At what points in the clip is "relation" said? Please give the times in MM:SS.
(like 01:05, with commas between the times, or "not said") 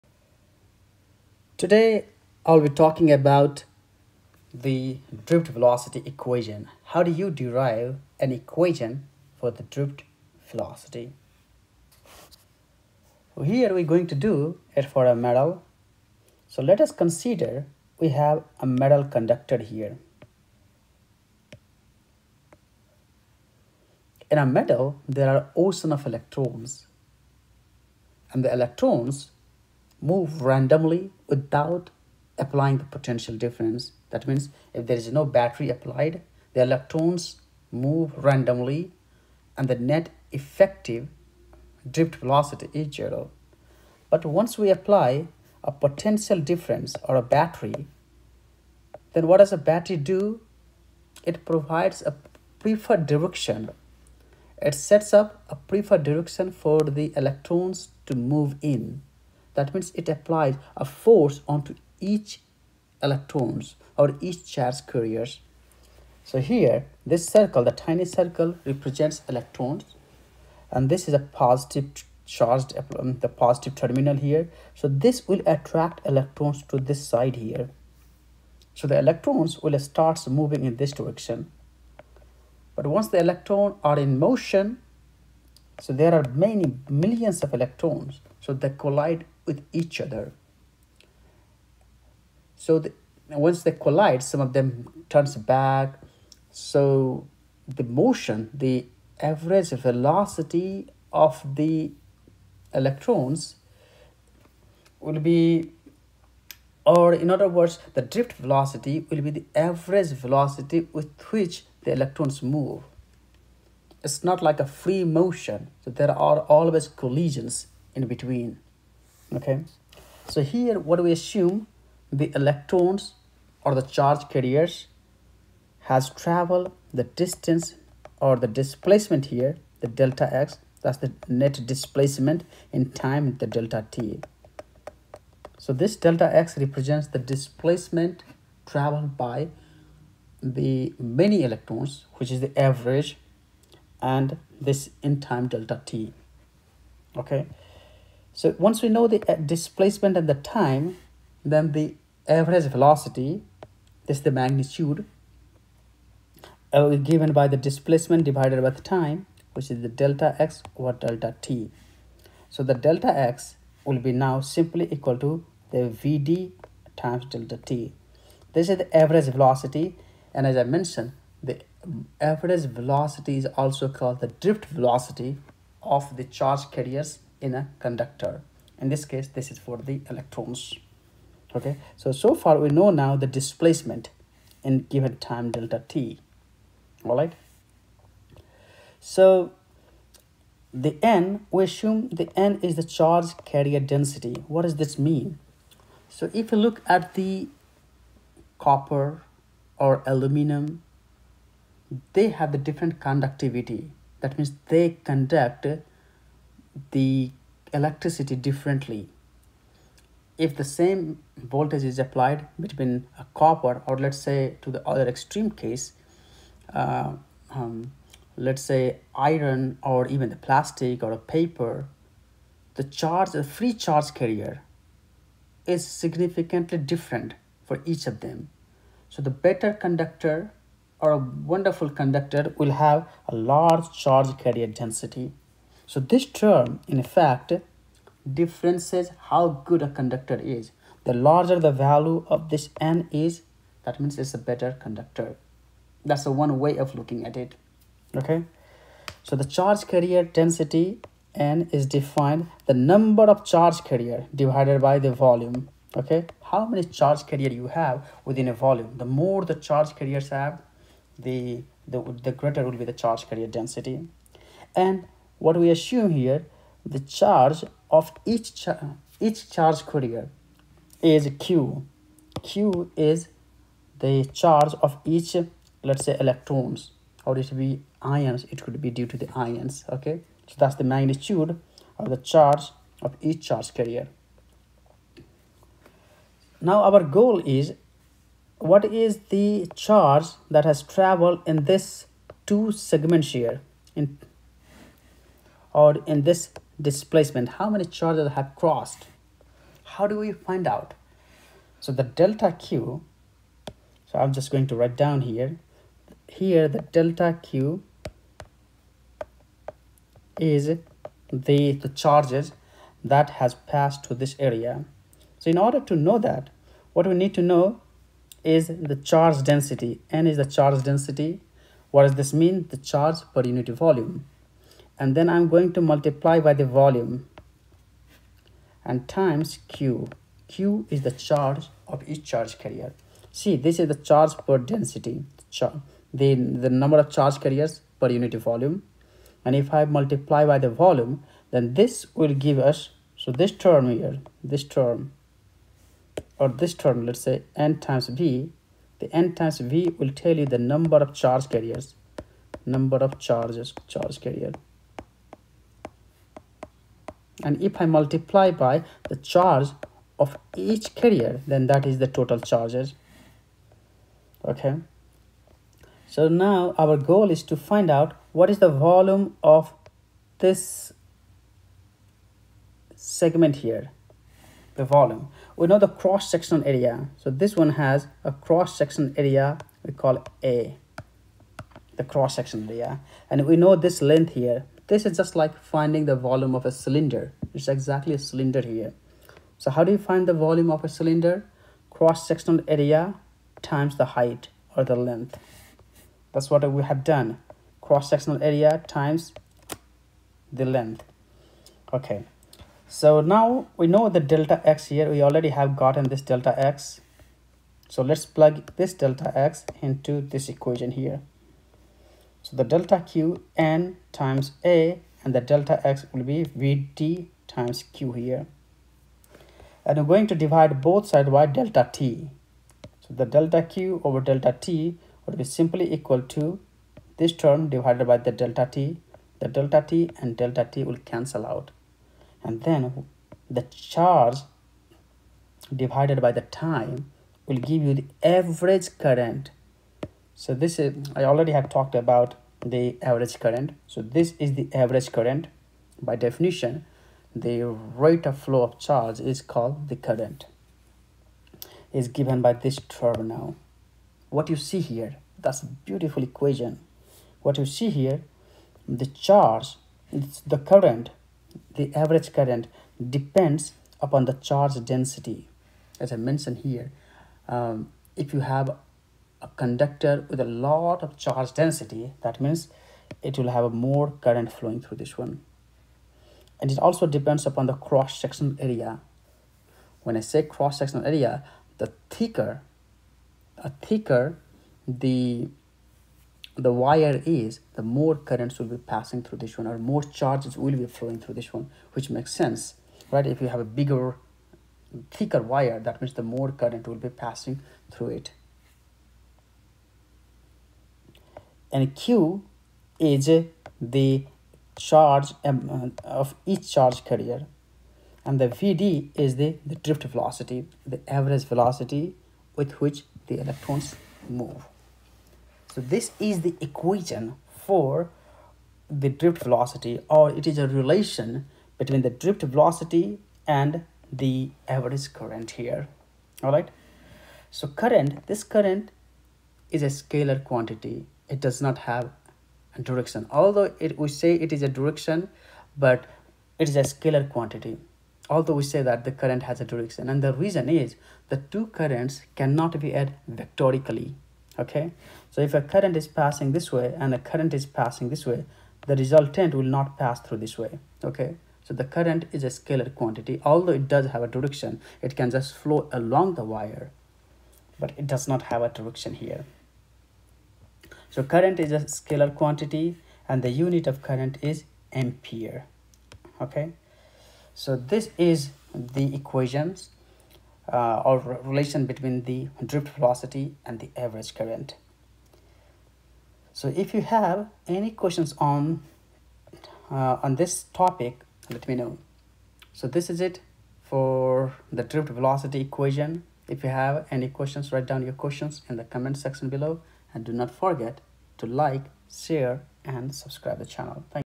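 08:40, 09:31.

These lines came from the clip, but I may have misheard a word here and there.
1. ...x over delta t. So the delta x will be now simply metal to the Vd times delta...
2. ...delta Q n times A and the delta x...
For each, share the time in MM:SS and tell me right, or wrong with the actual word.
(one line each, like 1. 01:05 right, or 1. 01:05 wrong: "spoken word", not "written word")
1. 02:40 wrong: "equal", not "metal"
2. 06:52 right.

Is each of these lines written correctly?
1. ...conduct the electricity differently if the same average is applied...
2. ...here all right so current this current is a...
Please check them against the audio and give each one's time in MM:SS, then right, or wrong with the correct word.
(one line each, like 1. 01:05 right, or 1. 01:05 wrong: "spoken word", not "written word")
1. 03:25 wrong: "voltage", not "average"
2. 08:45 right.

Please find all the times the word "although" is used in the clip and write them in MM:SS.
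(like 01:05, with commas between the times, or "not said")
08:53, 08:58, 09:13.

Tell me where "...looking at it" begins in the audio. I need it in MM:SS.
04:06.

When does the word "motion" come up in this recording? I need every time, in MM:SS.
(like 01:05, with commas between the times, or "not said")
01:24, 01:37, 01:55.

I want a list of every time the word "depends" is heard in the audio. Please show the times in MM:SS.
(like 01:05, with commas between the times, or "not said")
07:43, 07:57.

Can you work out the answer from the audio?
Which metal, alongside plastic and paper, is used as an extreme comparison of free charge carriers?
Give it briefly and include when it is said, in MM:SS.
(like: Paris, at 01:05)
iron, at 03:39.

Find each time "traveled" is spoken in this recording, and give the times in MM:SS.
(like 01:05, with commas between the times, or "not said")
02:06, 02:18, 04:50.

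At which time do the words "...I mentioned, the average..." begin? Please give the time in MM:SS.
02:50.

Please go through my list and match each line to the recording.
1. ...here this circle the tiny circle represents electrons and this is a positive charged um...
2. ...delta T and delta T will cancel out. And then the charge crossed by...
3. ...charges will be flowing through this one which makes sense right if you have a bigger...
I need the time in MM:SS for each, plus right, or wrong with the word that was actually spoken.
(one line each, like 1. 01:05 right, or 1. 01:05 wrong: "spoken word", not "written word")
1. 01:06 right
2. 07:09 wrong: "divided", not "crossed"
3. 08:10 right.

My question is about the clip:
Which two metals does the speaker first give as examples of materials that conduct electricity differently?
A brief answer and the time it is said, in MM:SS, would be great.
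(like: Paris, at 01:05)
copper or aluminum, at 03:18.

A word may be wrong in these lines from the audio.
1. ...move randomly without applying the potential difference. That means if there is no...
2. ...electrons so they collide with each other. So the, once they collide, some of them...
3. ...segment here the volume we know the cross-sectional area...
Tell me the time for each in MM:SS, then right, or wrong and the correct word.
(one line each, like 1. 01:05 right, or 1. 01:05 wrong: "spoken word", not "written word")
1. 00:30 right
2. 01:27 right
3. 06:12 right.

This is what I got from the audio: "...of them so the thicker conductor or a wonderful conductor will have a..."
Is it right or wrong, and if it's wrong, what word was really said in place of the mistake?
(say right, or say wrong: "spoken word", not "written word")
wrong: "better", not "thicker".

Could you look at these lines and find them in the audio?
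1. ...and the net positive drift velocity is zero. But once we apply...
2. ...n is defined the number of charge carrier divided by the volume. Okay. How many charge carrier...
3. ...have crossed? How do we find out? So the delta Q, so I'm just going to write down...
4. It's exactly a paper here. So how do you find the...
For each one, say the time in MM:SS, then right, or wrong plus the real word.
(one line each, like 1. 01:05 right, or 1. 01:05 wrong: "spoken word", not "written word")
1. 00:39 wrong: "effective", not "positive"
2. 04:11 right
3. 04:58 right
4. 06:27 wrong: "cylinder", not "paper".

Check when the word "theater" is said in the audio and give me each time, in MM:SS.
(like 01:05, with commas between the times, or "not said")
not said.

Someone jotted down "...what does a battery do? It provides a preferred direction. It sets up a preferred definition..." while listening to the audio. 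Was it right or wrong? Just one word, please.
wrong.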